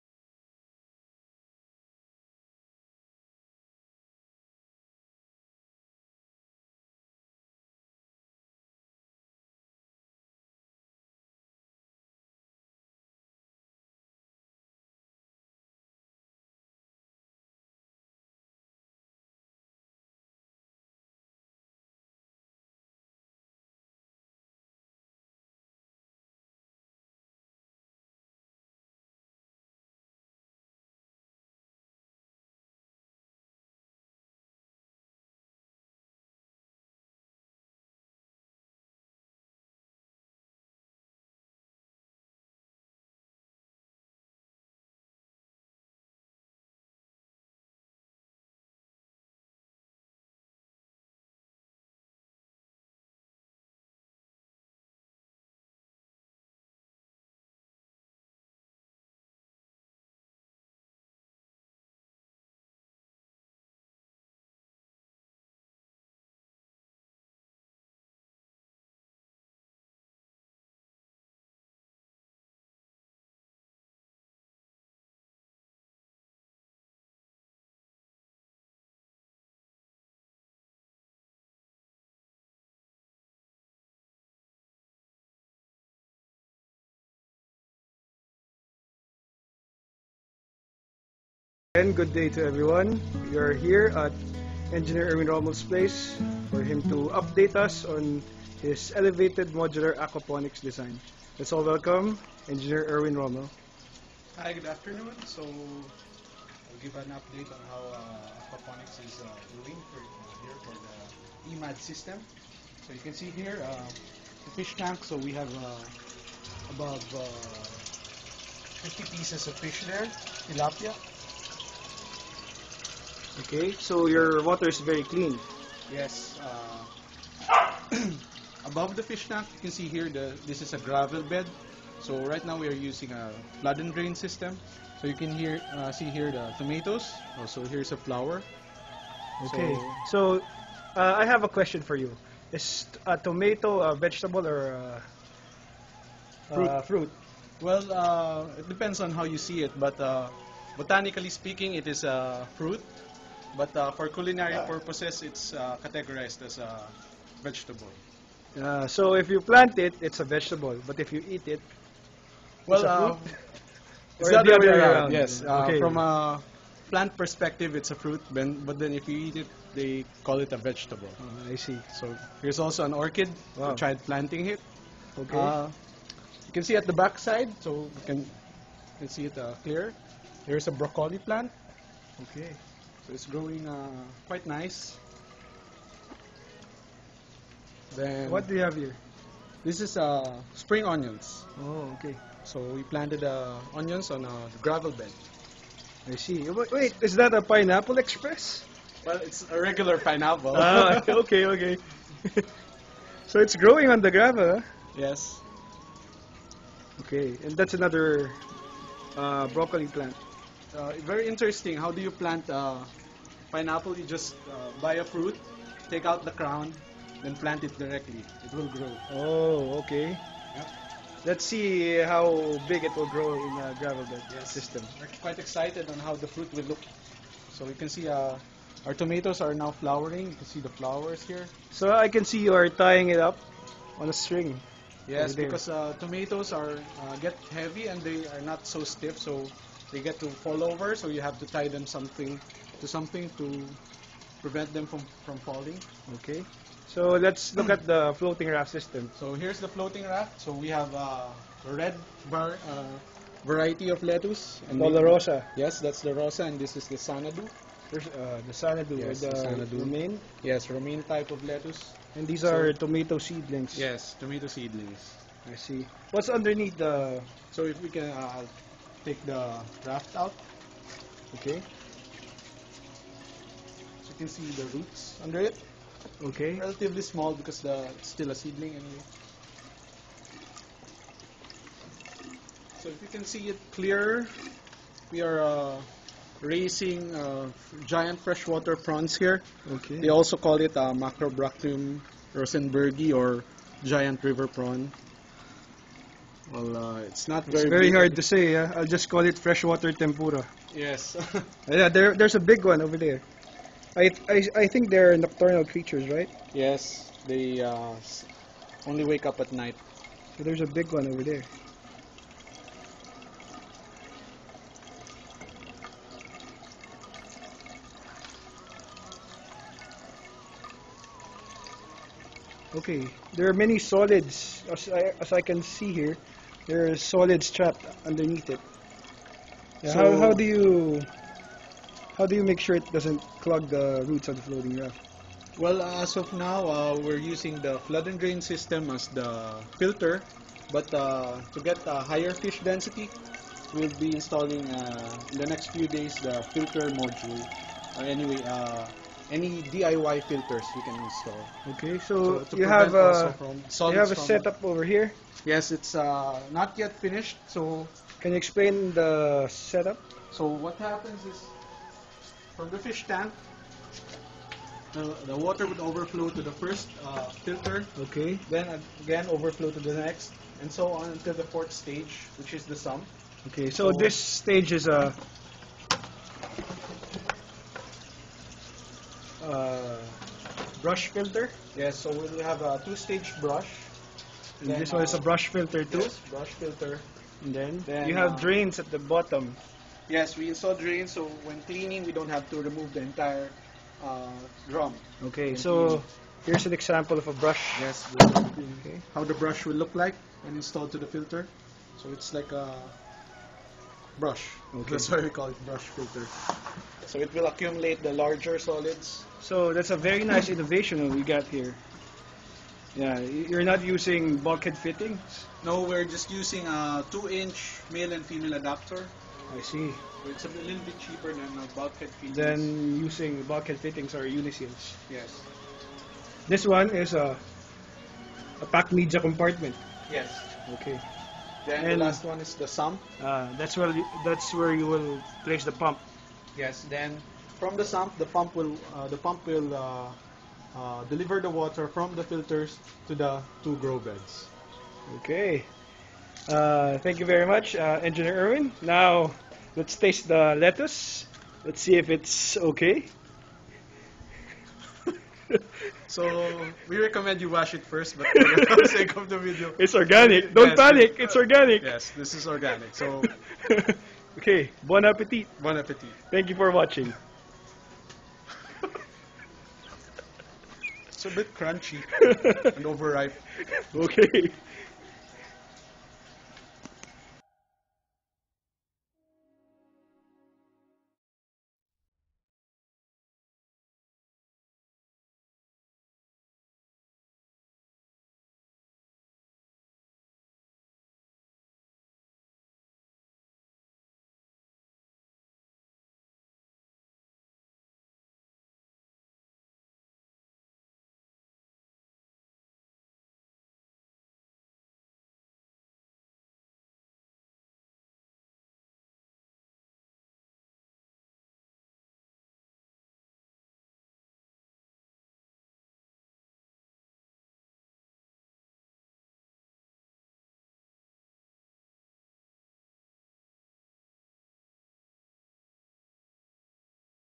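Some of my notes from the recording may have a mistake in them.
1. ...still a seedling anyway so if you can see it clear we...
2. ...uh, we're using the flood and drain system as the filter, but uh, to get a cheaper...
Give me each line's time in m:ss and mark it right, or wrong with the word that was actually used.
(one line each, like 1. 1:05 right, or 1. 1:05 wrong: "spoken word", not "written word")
1. 4:38 right
2. 5:36 wrong: "higher", not "cheaper".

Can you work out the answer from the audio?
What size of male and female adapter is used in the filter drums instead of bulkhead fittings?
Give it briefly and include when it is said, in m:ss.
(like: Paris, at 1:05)
2-inch, at 6:57.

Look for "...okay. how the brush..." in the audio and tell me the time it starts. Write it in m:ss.
6:38.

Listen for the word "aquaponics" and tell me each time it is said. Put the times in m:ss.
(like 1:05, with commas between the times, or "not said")
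1:39, 1:48.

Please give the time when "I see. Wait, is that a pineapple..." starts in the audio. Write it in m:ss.
3:16.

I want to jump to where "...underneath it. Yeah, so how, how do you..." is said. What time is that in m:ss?
5:28.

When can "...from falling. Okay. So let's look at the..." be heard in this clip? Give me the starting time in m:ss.
4:05.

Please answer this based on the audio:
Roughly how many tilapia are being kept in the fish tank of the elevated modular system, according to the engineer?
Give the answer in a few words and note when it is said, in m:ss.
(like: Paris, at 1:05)
50, at 1:58.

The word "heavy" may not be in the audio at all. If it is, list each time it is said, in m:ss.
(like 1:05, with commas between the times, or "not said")
3:57.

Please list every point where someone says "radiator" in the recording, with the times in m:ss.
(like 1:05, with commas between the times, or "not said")
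not said.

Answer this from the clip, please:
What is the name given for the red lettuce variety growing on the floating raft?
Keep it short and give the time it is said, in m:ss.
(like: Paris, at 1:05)
rosa, at 4:16.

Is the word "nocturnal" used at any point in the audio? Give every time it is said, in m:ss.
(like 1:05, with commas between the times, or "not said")
5:05.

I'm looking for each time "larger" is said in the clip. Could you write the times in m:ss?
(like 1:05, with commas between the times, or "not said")
6:48.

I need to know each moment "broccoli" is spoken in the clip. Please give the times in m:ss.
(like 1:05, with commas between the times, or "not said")
3:00, 3:29.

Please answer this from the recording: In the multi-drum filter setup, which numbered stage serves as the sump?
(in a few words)
fourth.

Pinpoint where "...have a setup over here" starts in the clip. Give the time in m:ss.
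5:54.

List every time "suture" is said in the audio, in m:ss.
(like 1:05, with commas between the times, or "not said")
not said.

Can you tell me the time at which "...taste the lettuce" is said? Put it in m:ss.
7:29.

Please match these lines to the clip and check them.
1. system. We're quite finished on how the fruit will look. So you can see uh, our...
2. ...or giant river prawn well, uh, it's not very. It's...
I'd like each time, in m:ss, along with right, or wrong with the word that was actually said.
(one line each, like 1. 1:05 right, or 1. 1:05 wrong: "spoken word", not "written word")
1. 3:44 wrong: "excited", not "finished"
2. 4:53 right.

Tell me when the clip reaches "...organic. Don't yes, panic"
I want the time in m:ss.
7:39.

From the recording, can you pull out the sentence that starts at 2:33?
But uh, for culinary purposes, it's uh, categorized as a vegetable.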